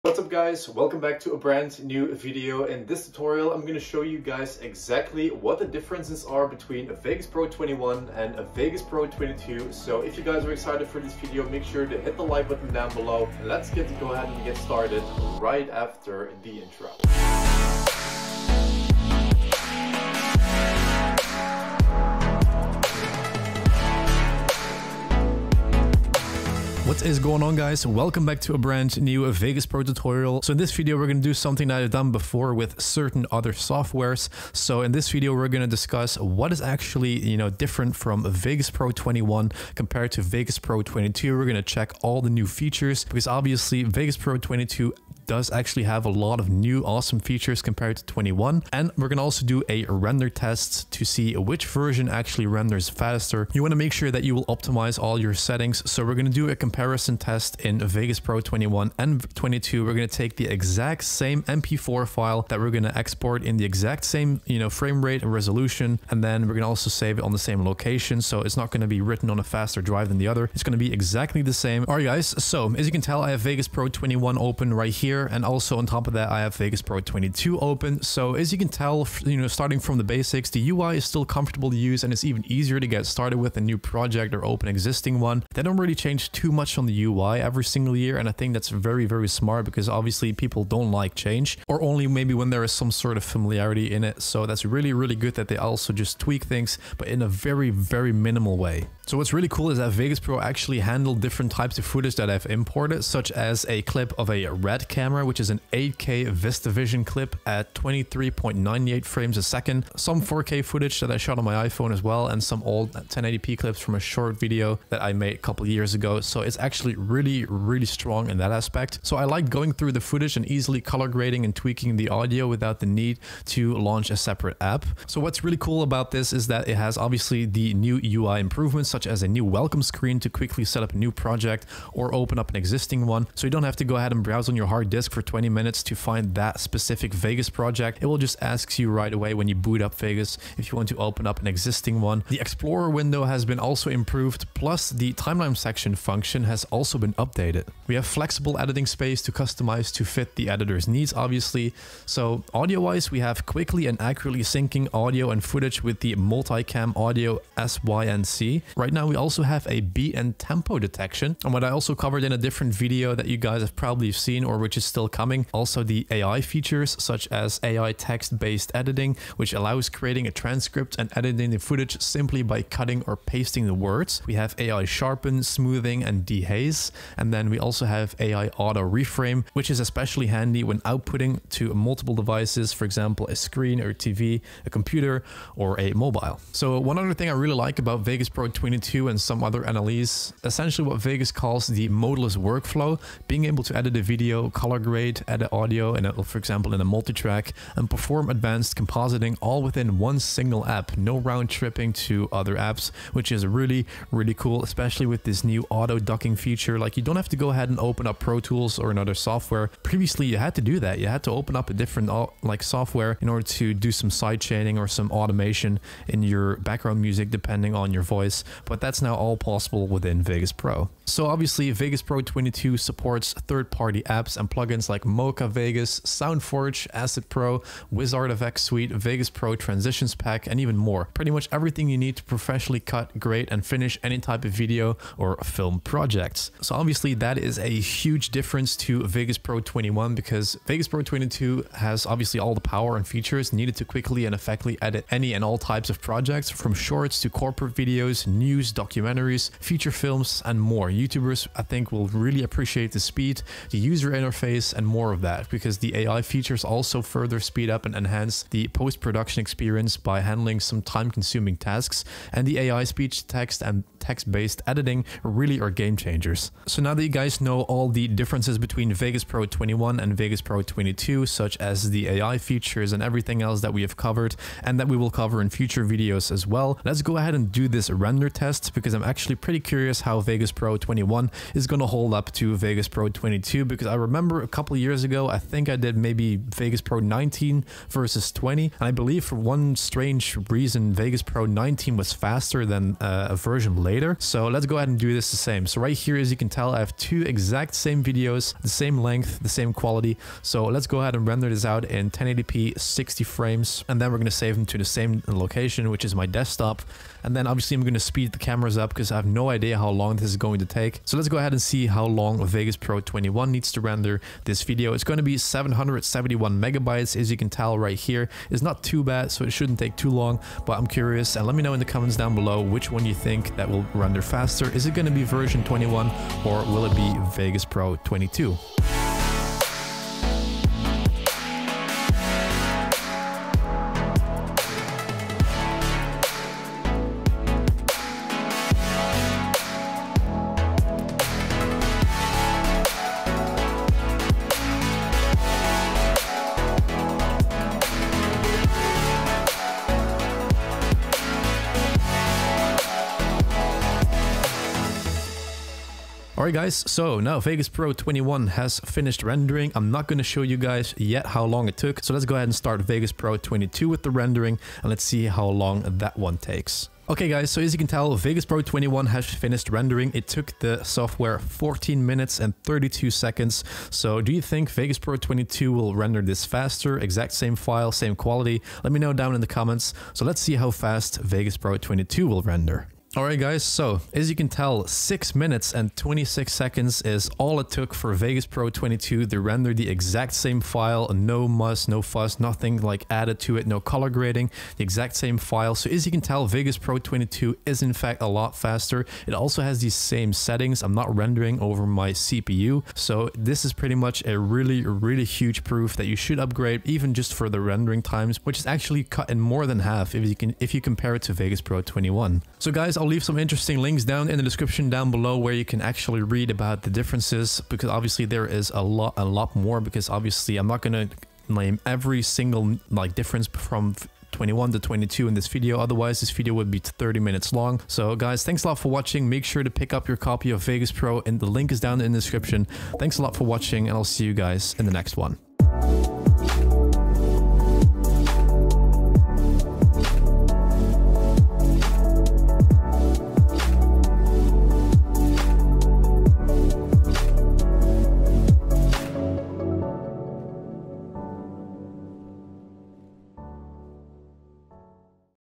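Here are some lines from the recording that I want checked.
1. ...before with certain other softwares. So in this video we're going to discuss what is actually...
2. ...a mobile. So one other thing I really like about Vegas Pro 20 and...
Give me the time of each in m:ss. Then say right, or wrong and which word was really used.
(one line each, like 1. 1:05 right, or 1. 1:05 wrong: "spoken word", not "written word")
1. 0:32 right
2. 3:05 right.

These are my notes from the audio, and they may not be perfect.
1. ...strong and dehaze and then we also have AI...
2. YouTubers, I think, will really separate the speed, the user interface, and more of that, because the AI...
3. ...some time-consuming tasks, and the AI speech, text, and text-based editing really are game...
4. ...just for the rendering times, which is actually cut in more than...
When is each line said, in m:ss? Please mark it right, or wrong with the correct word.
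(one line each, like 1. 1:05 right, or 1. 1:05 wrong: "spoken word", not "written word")
1. 2:55 wrong: "smoothing", not "strong"
2. 4:10 wrong: "appreciate", not "separate"
3. 4:20 right
4. 6:47 right.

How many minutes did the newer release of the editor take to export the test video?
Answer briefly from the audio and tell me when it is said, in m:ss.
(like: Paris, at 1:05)
6, at 6:24.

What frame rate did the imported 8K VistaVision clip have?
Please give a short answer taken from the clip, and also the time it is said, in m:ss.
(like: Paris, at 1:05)
23.98, at 1:47.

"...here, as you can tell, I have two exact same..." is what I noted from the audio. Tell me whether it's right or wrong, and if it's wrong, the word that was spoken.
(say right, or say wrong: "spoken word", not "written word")
right.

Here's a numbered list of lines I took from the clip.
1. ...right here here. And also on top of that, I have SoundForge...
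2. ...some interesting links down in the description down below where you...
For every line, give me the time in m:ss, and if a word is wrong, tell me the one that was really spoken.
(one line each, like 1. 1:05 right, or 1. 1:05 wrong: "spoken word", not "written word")
1. 1:14 wrong: "Vegas", not "SoundForge"
2. 6:53 right.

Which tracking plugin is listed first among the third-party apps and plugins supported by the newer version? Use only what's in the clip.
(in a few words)
Mocha Vegas.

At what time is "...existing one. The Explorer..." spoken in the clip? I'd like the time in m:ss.
2:21.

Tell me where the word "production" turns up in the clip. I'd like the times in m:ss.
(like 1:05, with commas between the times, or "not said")
4:18.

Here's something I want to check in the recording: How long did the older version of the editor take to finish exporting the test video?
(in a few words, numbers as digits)
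14 minutes 32 seconds.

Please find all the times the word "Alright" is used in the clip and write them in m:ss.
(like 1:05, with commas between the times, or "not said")
5:56, 6:23.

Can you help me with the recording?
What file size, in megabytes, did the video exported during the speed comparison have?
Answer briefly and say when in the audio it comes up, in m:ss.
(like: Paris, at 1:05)
771, at 5:15.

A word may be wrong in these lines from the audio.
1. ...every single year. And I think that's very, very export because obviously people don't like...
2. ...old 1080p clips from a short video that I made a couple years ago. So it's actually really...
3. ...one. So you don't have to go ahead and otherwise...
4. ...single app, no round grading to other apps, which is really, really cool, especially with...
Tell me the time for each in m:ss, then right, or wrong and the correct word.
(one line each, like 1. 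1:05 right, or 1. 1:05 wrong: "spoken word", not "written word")
1. 1:27 wrong: "smart", not "export"
2. 1:52 right
3. 2:13 wrong: "browse", not "otherwise"
4. 3:20 wrong: "tripping", not "grading".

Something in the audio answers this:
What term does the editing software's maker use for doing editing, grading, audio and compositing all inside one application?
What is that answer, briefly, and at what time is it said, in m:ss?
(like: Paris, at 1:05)
modeless workflow, at 3:11.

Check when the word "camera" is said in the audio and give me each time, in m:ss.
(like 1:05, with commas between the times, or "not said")
1:44, 5:08.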